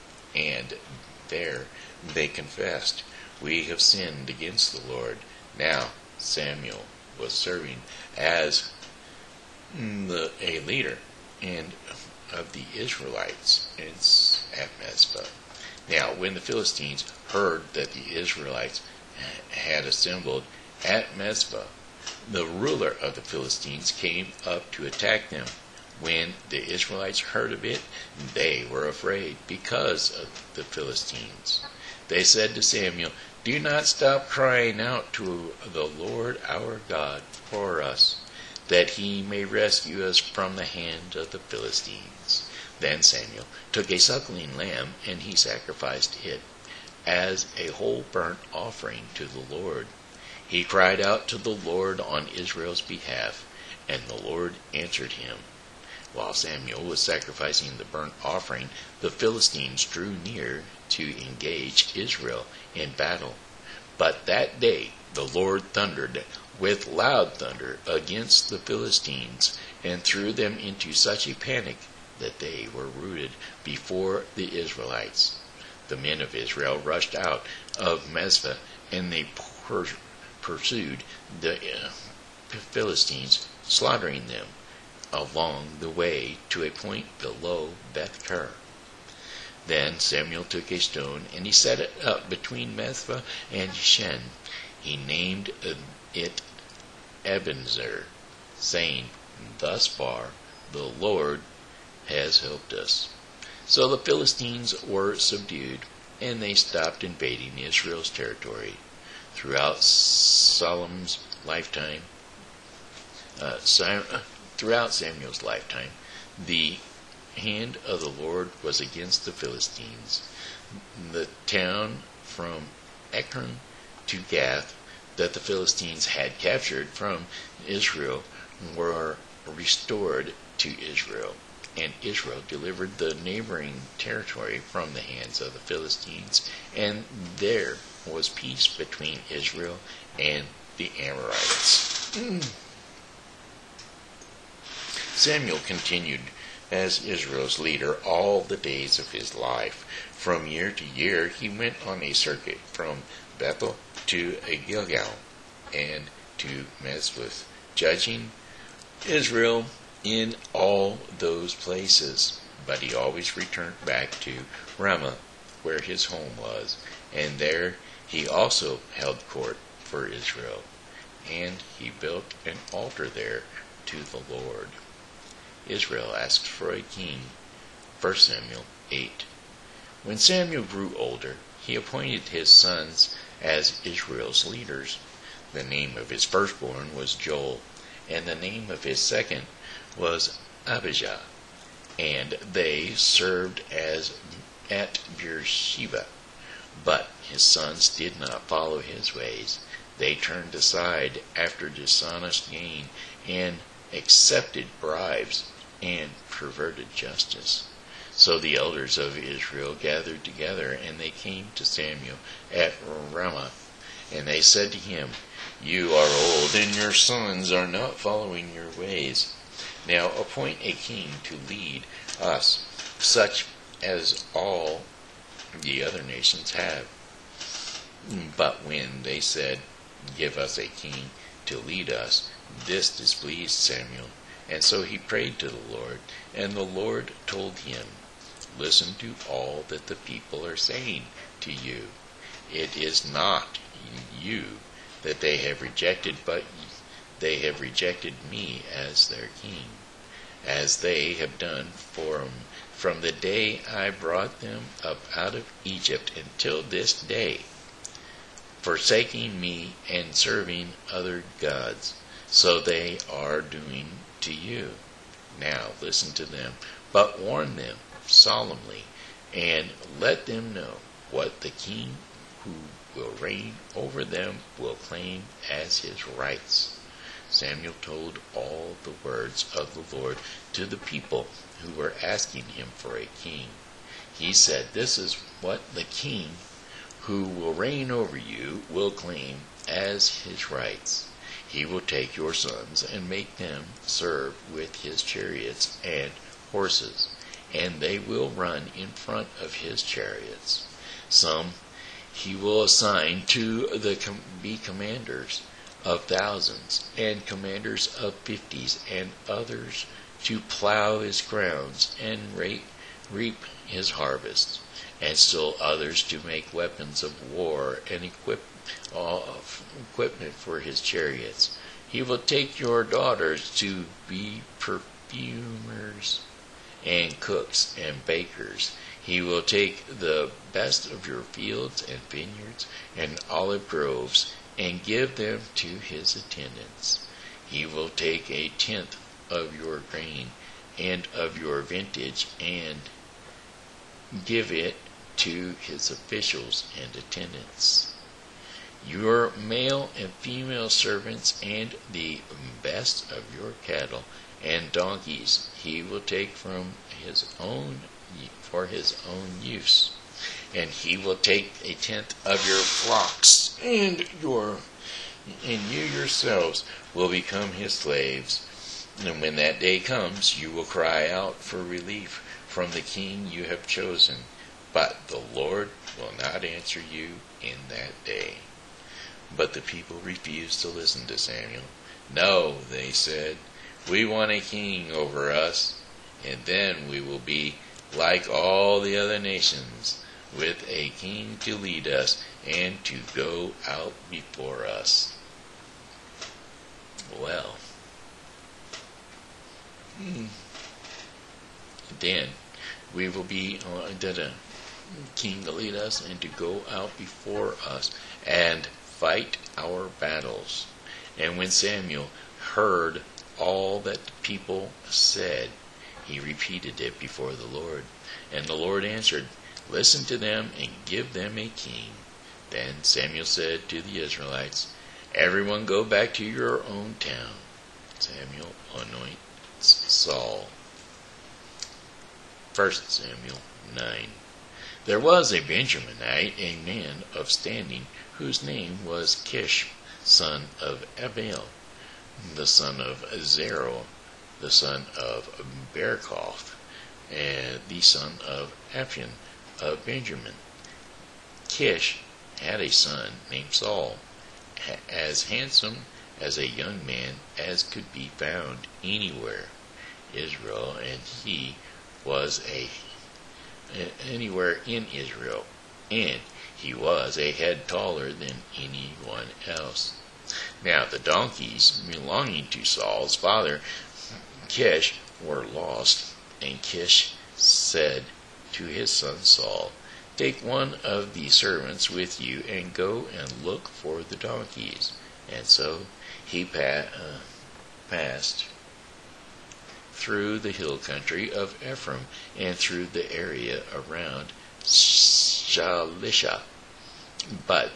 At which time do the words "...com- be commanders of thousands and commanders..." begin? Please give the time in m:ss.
5:03.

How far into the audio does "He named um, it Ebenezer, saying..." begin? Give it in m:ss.
1:34.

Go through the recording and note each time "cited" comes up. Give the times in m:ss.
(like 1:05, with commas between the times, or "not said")
not said.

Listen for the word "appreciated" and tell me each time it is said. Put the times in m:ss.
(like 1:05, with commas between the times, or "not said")
not said.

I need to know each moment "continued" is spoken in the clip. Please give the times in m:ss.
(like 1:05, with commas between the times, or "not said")
2:25.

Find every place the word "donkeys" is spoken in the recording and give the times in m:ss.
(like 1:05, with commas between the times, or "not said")
5:54, 7:50, 8:04.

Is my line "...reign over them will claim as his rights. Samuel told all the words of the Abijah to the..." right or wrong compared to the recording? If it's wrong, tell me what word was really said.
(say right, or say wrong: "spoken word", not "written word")
wrong: "Lord", not "Abijah".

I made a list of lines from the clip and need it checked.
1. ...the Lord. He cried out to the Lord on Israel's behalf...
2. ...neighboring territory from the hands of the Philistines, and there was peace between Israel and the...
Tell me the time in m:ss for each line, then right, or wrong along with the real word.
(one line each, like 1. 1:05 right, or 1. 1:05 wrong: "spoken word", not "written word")
1. 0:49 right
2. 2:13 right.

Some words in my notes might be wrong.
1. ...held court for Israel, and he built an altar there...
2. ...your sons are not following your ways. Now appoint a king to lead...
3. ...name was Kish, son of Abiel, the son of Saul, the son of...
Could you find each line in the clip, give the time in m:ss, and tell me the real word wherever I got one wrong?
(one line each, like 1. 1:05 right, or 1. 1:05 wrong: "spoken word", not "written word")
1. 2:48 right
2. 3:36 right
3. 7:18 wrong: "Zerah", not "Saul".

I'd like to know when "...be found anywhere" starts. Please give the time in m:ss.
7:37.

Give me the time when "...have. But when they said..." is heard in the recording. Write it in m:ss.
3:46.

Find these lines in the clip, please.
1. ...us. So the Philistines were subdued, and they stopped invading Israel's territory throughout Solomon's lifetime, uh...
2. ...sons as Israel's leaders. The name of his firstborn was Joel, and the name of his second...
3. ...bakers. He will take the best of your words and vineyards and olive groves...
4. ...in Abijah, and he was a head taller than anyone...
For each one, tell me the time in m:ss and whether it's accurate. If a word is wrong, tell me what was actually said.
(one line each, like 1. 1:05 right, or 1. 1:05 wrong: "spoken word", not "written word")
1. 1:42 right
2. 3:02 right
3. 5:28 wrong: "fields", not "words"
4. 7:44 wrong: "Israel", not "Abijah".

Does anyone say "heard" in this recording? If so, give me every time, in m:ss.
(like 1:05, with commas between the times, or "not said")
0:17, 0:27, 6:52.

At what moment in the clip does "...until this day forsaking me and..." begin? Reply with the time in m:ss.
4:16.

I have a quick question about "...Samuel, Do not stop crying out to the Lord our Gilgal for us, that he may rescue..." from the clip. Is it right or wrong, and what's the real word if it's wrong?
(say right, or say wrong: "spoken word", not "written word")
wrong: "God", not "Gilgal".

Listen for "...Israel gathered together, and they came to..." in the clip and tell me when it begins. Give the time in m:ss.
3:29.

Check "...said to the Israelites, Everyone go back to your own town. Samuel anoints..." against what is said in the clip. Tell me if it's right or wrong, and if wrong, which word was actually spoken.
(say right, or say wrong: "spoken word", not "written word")
right.